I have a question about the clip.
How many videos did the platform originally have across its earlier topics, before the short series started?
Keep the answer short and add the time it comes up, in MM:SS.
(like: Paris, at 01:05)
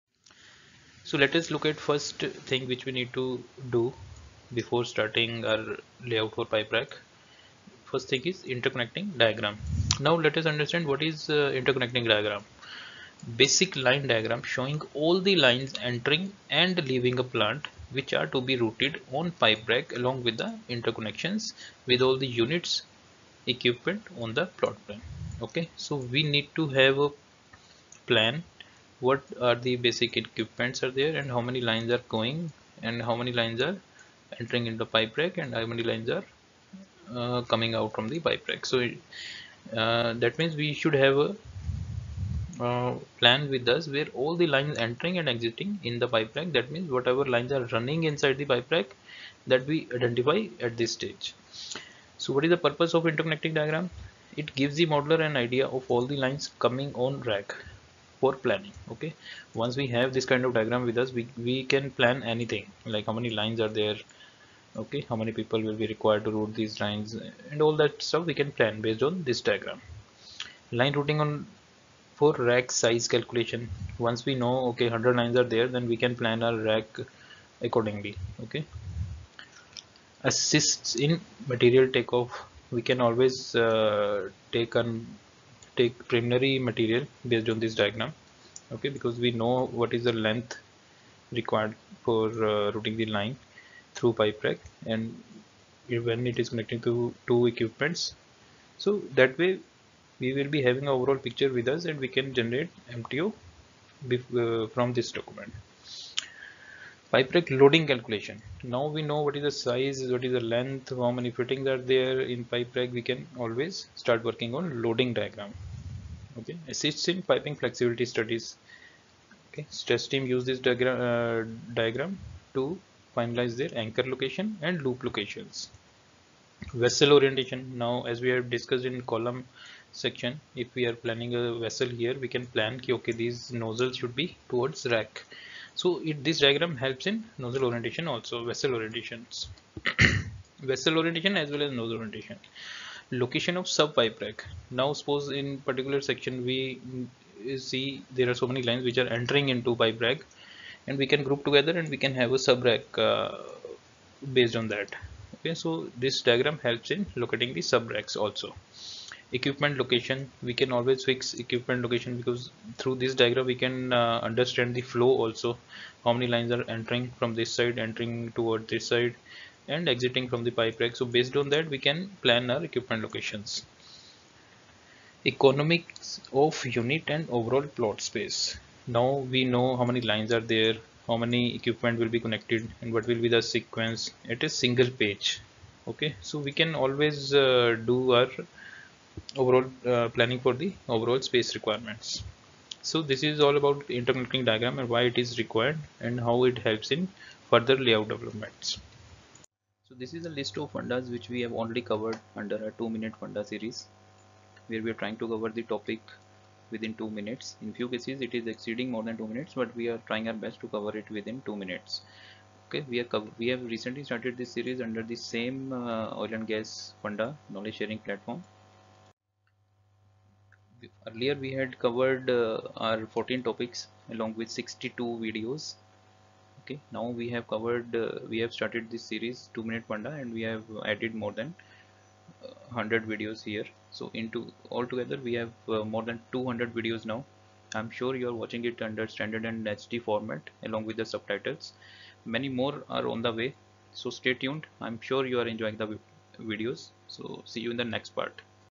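62, at 03:44.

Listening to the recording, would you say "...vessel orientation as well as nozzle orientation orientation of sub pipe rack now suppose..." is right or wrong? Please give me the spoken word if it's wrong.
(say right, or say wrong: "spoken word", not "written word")
wrong: "location", not "orientation".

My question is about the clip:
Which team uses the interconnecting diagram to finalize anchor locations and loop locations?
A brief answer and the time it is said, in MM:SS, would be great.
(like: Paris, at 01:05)
Stress team, at 01:59.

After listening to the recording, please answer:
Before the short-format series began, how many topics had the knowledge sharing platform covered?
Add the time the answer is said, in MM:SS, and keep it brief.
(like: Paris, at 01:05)
14, at 03:43.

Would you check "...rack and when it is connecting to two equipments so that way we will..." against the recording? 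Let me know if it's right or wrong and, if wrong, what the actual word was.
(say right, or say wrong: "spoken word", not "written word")
right.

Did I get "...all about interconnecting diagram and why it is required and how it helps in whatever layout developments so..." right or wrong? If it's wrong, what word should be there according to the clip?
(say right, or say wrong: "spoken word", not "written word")
wrong: "further", not "whatever".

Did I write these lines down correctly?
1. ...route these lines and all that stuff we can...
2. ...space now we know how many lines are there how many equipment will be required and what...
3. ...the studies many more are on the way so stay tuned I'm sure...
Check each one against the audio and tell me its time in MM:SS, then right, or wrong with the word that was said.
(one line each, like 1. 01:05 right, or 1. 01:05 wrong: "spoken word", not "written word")
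1. 01:06 right
2. 02:58 wrong: "connected", not "required"
3. 04:00 wrong: "subtitles", not "studies".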